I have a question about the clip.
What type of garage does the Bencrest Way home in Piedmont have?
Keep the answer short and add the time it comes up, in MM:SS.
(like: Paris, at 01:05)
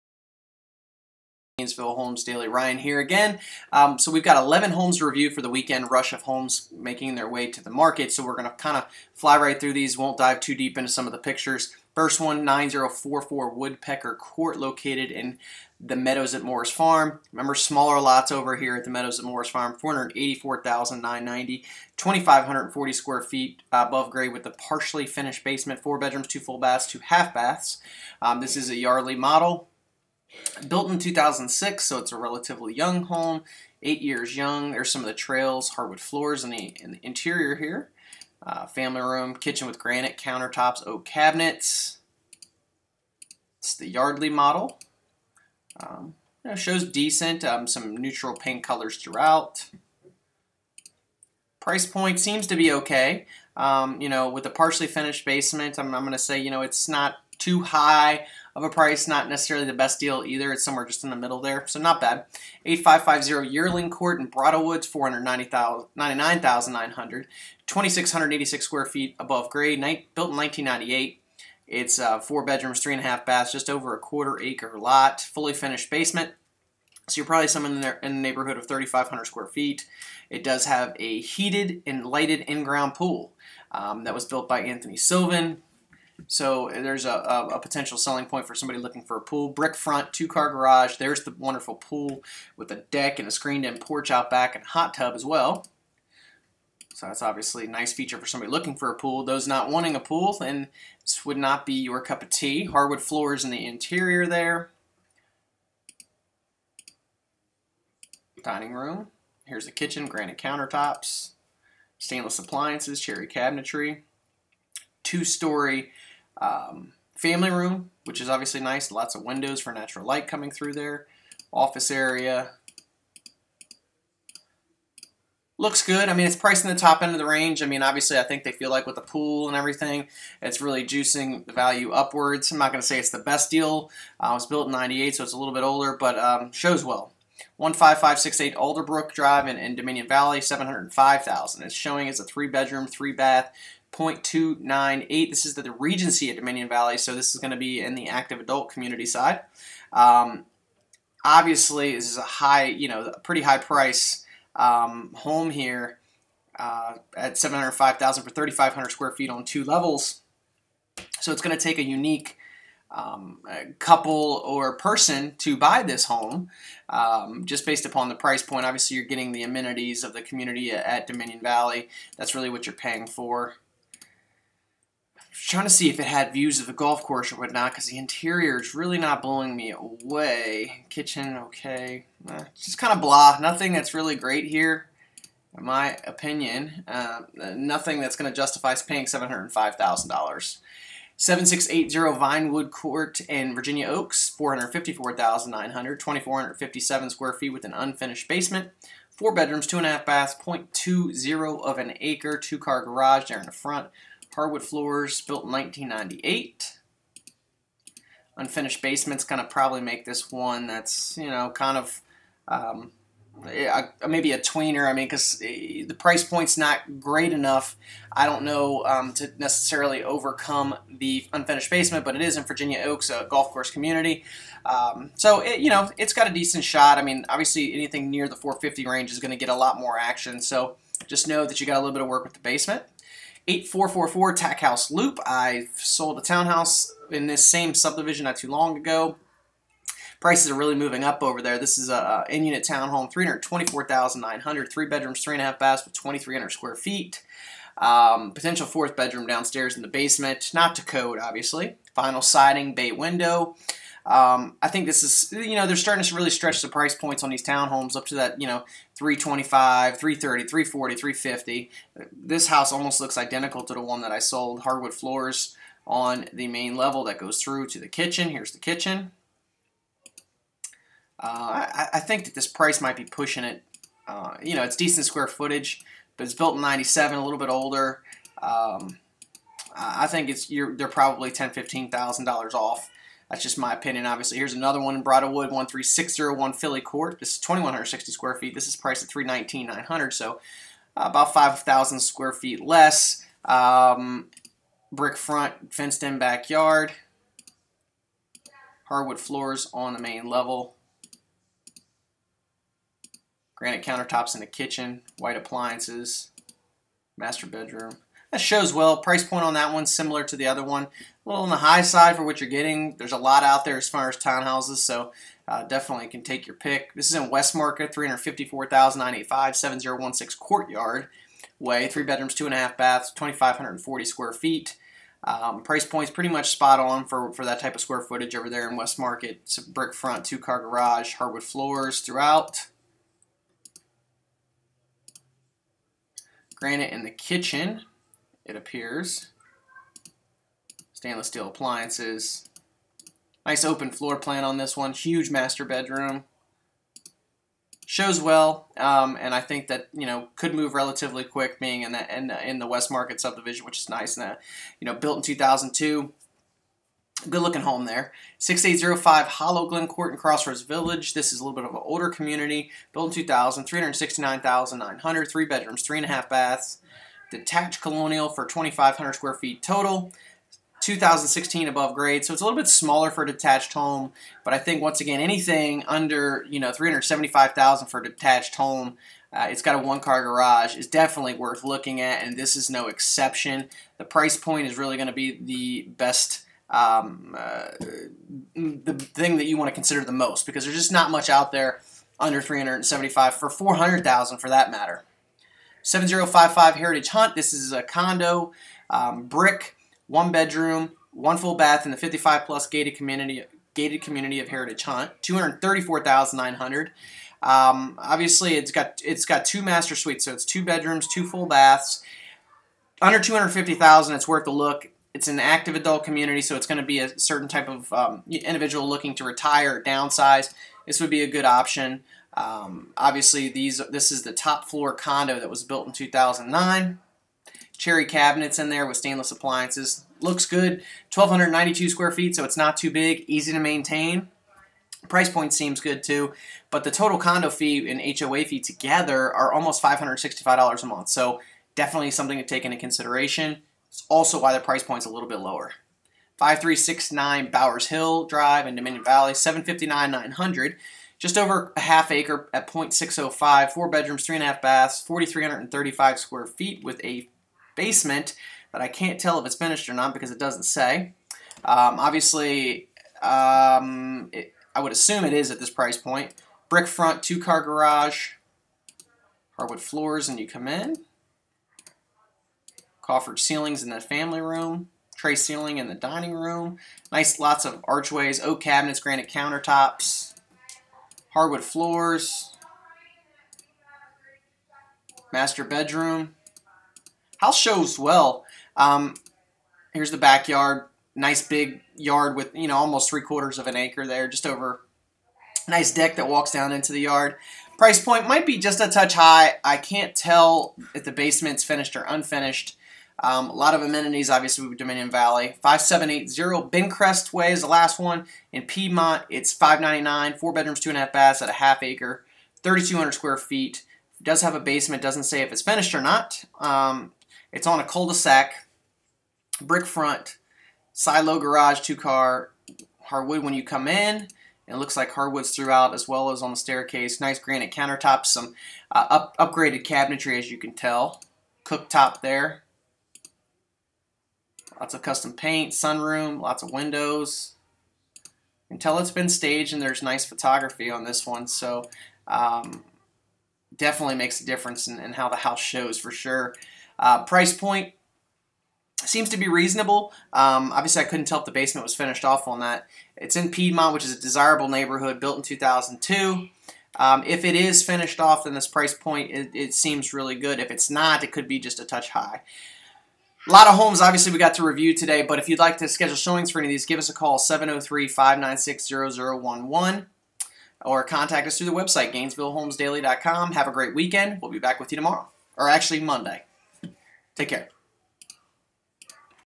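Silo garage, at 08:40.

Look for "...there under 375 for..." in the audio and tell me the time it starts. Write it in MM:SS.
06:31.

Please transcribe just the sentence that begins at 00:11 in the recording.
First one, 9044 Woodpecker Court, located in the Meadows at Morris Farm.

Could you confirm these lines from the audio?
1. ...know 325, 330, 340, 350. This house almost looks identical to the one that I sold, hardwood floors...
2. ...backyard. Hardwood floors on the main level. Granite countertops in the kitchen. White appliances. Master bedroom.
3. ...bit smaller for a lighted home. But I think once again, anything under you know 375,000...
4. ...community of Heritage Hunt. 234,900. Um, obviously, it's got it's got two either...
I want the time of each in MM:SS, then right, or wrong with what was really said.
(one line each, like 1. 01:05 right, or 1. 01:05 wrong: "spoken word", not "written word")
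1. 04:18 right
2. 04:56 right
3. 06:12 wrong: "detached", not "lighted"
4. 06:44 wrong: "master", not "either".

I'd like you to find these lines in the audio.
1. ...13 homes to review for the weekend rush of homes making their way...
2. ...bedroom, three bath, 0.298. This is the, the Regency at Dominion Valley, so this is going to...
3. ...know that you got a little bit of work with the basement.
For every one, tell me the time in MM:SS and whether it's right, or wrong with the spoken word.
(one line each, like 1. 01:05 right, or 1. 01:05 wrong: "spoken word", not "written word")
1. 00:04 wrong: "11", not "13"
2. 02:22 right
3. 03:51 right.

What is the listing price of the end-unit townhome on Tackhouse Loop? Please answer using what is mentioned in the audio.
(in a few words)
$324,900.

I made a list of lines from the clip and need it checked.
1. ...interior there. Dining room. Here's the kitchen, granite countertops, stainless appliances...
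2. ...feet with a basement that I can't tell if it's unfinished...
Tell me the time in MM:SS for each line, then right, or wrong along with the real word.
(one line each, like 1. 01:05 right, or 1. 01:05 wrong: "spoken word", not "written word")
1. 01:43 right
2. 07:36 wrong: "finished", not "unfinished".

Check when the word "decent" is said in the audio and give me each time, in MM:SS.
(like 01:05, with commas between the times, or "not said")
00:46, 03:46, 04:34.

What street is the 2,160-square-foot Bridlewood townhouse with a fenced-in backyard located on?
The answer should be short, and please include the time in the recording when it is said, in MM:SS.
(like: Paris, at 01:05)
Filly Court, at 04:45.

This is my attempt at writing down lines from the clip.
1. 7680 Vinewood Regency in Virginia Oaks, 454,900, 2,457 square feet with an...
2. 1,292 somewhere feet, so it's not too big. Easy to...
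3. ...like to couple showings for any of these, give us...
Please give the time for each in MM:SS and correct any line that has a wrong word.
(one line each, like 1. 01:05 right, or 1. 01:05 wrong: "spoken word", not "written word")
1. 03:11 wrong: "Court", not "Regency"
2. 07:11 wrong: "square", not "somewhere"
3. 09:25 wrong: "schedule", not "couple".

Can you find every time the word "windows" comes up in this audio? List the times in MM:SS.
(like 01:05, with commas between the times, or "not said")
01:59, 04:12, 08:56.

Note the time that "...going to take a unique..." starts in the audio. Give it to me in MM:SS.
02:41.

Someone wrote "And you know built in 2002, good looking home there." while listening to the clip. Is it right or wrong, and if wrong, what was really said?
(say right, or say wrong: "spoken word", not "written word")
right.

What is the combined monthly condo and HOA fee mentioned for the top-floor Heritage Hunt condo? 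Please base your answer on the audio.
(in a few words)
$565.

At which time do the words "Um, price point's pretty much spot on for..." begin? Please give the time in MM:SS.
05:25.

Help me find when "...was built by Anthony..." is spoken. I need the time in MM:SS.
01:24.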